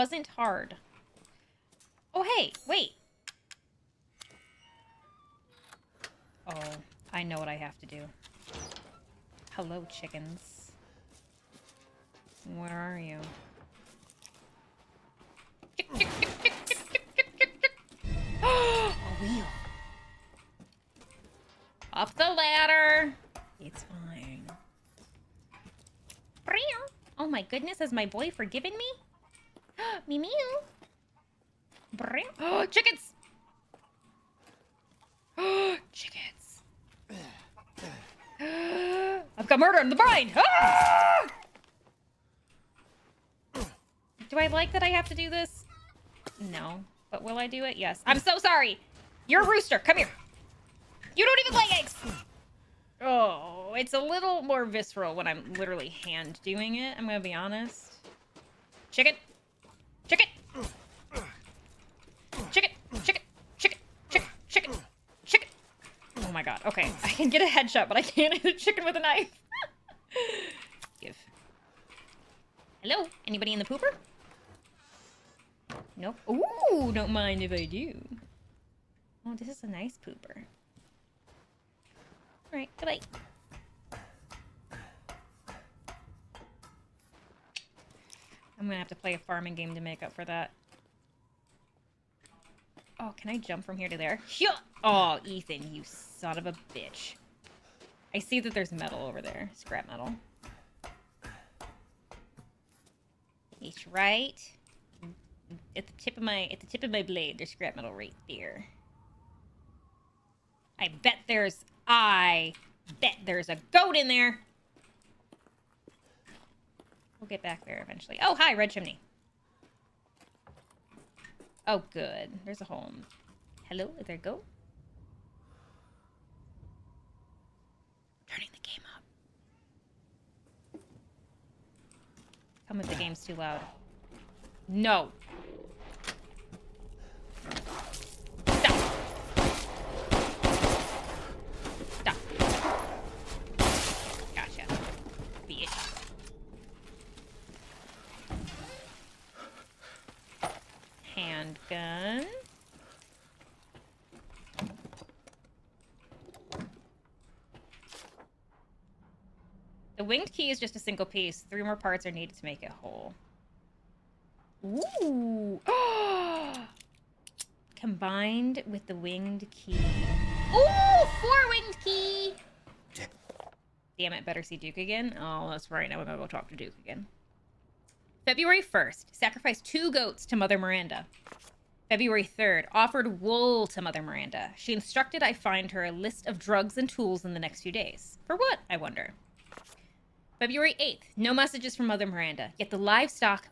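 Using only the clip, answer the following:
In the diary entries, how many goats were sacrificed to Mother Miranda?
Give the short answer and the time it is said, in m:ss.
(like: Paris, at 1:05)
2, at 2:59.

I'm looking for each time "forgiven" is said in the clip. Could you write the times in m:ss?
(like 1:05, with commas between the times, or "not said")
0:28.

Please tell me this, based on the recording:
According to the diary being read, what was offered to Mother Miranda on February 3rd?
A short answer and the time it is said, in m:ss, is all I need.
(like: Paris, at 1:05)
Wool, at 3:02.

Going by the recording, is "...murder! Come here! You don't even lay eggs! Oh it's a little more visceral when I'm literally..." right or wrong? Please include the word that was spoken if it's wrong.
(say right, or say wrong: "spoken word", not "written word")
wrong: "rooster", not "murder".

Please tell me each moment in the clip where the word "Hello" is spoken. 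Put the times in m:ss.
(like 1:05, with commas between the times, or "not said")
0:09, 1:12, 2:03.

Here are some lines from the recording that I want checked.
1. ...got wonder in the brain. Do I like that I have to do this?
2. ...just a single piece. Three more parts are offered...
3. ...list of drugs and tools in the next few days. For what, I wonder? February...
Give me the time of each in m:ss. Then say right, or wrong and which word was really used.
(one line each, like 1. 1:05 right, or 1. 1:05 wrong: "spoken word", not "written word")
1. 0:39 wrong: "murder", not "wonder"
2. 2:40 wrong: "needed", not "offered"
3. 3:05 right.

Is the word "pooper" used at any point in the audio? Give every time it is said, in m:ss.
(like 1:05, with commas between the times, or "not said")
1:13, 1:20.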